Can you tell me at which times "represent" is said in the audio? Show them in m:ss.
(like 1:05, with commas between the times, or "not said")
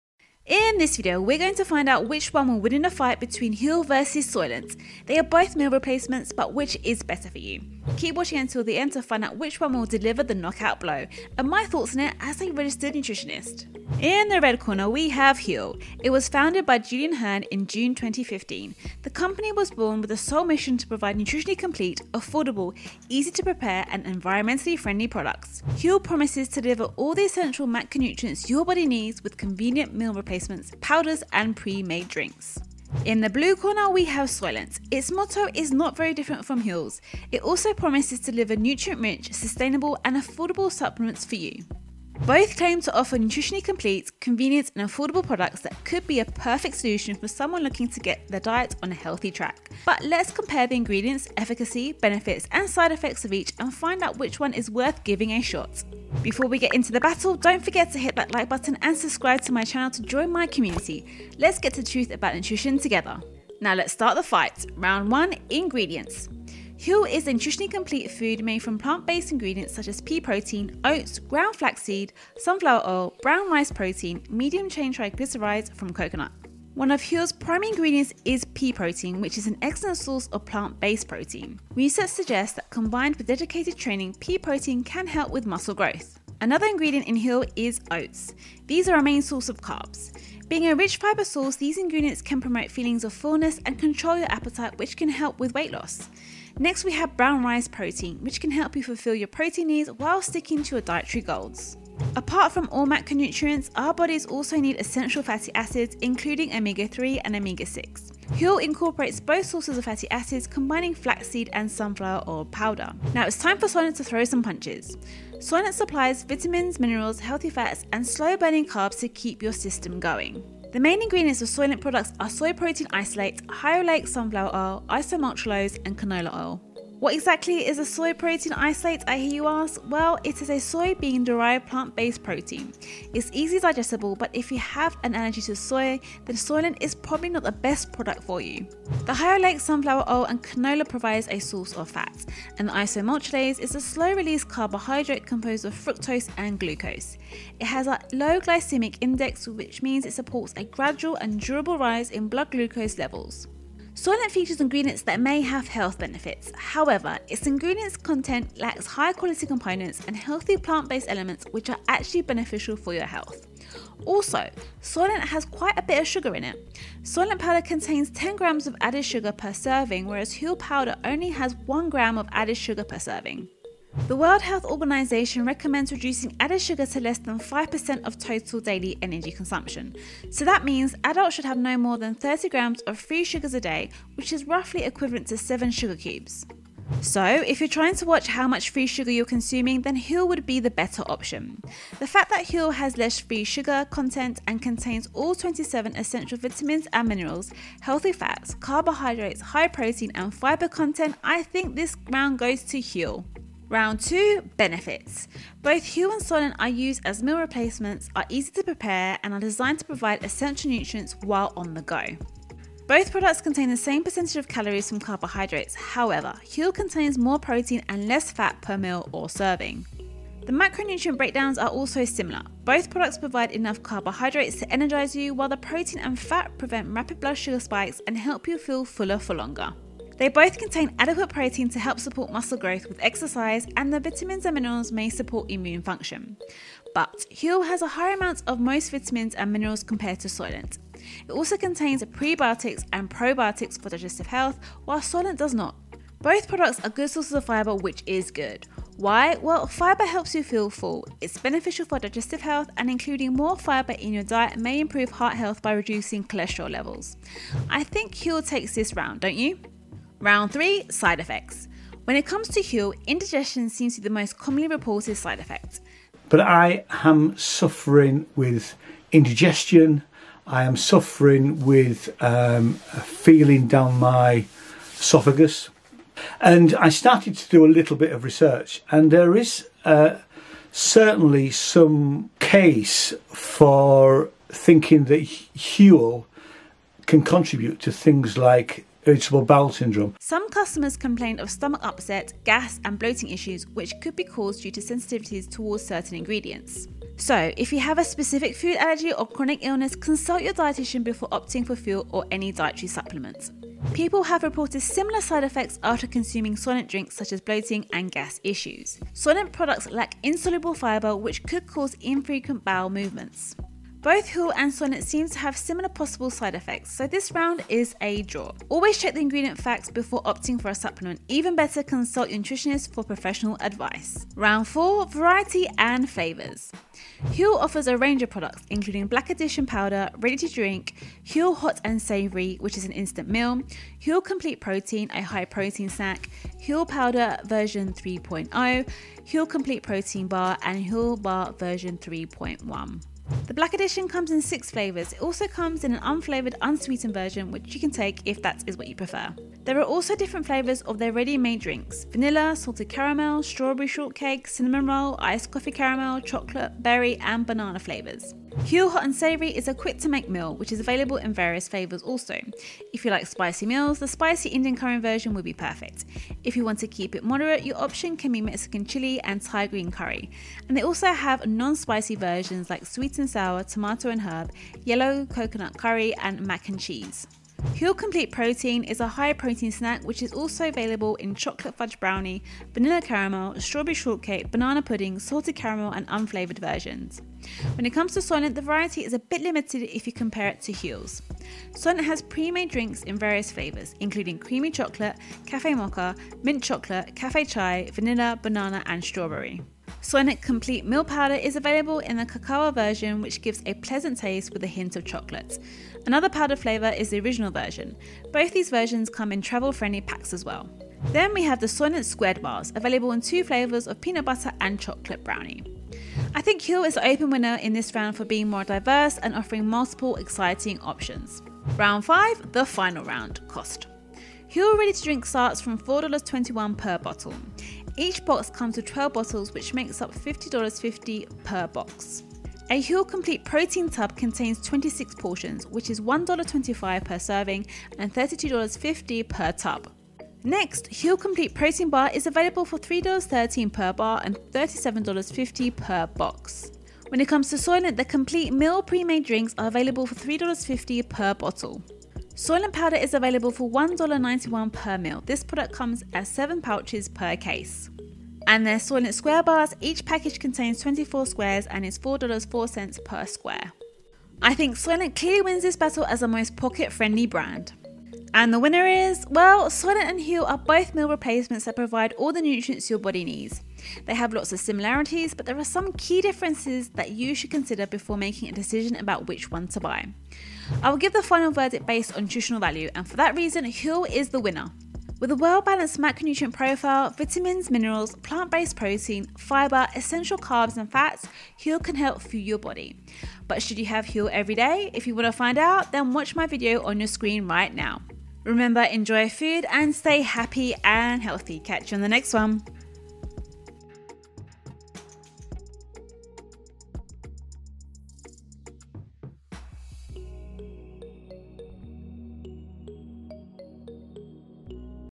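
not said.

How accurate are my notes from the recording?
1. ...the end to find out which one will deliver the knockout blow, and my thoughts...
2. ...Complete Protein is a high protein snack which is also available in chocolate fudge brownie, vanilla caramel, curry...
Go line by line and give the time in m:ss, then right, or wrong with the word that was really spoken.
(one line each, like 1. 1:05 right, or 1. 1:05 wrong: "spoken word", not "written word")
1. 0:08 right
2. 6:17 wrong: "strawberry", not "curry".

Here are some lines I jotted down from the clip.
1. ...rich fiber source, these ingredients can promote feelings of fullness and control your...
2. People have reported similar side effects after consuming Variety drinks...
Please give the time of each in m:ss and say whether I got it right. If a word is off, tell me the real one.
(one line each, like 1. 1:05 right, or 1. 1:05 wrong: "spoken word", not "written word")
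1. 1:30 right
2. 5:03 wrong: "Soylent", not "Variety".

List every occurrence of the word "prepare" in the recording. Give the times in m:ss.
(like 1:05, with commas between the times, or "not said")
0:23, 3:28.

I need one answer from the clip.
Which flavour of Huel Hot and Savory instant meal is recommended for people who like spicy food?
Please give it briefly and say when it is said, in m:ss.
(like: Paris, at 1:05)
spicy Indian curry, at 6:04.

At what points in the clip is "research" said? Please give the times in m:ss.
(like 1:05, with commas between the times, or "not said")
1:21, 4:38.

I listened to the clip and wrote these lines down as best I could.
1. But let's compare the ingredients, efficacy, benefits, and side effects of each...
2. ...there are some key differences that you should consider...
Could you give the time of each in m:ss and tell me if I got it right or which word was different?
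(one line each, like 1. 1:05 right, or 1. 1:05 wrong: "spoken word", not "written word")
1. 0:49 right
2. 7:55 right.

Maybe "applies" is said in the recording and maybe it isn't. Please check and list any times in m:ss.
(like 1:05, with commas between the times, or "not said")
not said.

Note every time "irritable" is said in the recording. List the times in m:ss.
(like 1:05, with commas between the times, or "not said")
4:49.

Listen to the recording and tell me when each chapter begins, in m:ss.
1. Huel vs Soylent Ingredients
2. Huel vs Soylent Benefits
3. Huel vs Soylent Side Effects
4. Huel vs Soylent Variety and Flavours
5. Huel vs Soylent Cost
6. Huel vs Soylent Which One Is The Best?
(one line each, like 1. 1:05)
1. 1:05
2. 3:24
3. 4:20
4. 5:25
5. 7:02
6. 7:48.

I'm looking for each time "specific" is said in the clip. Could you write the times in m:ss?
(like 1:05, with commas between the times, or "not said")
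4:58.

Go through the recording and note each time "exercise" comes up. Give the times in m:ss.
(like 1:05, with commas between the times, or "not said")
3:53.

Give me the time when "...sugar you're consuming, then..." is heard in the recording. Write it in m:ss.
3:08.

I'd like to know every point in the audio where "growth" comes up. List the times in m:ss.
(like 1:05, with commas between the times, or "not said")
1:25, 3:52.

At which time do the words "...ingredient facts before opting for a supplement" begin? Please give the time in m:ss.
5:19.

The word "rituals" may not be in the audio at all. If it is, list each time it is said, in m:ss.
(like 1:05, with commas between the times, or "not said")
not said.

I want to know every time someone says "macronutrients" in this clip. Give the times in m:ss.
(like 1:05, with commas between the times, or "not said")
0:27, 1:42, 3:40, 8:05.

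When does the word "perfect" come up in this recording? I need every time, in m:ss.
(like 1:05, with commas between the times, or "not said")
0:46, 6:05.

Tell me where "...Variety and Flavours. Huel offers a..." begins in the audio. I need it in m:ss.
5:25.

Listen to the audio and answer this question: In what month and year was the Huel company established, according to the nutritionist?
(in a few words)
June 2015.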